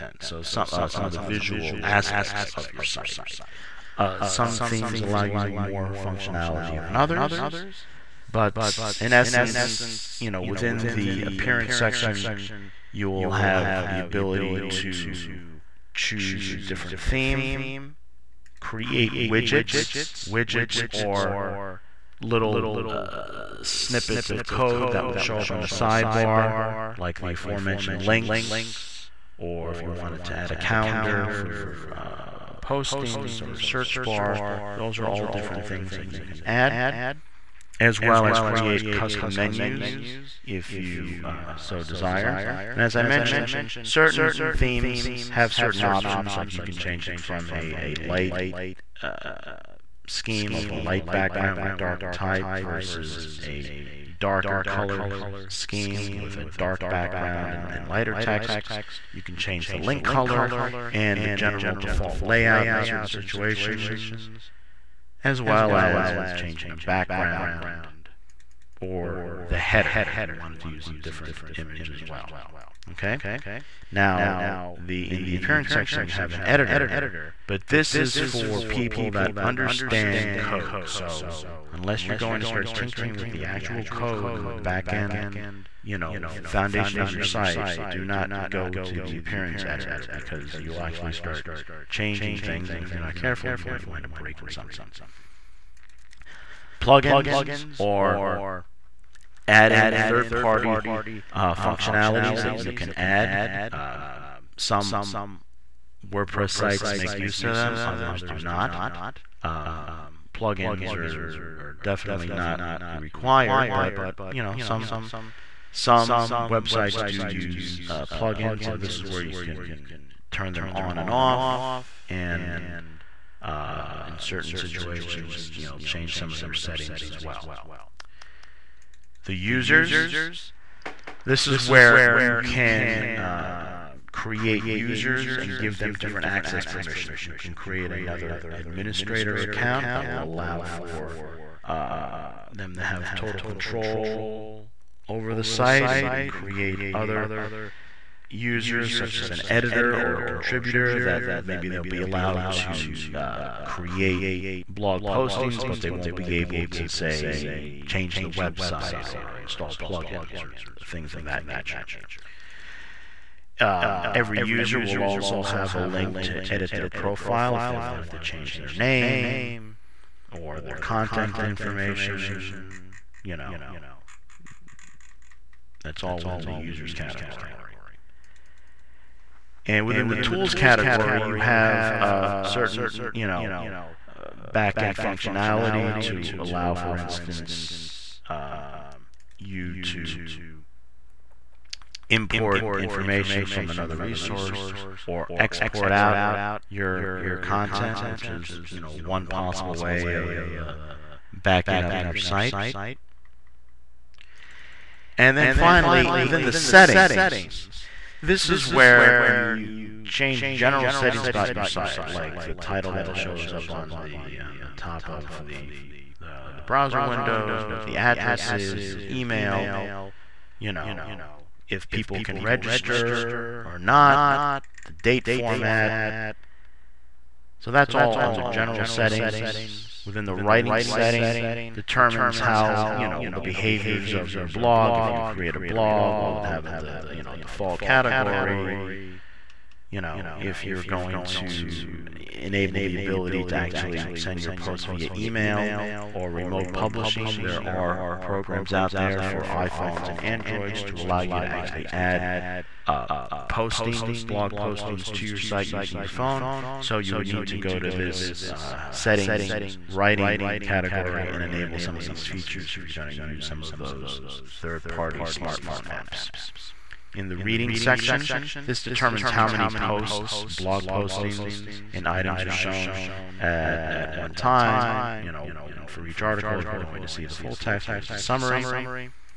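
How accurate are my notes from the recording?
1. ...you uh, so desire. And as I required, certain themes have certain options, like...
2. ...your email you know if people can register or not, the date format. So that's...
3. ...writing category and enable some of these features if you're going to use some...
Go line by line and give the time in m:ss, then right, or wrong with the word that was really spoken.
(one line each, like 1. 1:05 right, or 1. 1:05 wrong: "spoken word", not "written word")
1. 0:40 wrong: "mentioned", not "required"
2. 3:38 right
3. 4:19 right.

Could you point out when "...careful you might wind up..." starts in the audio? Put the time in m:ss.
1:33.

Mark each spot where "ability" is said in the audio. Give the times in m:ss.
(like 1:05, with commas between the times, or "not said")
0:13, 4:02.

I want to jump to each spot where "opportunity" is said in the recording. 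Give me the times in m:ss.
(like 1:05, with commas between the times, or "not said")
not said.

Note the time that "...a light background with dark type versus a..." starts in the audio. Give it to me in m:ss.
0:50.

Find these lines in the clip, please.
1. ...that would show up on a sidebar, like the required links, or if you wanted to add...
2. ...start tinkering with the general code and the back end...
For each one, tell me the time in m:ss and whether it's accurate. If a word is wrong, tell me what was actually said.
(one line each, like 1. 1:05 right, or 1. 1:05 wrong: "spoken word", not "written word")
1. 0:24 wrong: "aforementioned", not "required"
2. 1:22 wrong: "actual", not "general".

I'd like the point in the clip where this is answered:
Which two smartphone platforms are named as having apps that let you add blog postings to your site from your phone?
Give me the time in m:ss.
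4:09.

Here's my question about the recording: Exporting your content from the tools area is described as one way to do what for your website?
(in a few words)
backing up your site.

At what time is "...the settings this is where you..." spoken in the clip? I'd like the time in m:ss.
3:26.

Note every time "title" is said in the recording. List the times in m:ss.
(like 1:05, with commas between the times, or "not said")
3:32.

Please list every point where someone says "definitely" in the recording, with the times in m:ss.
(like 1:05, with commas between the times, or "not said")
1:51.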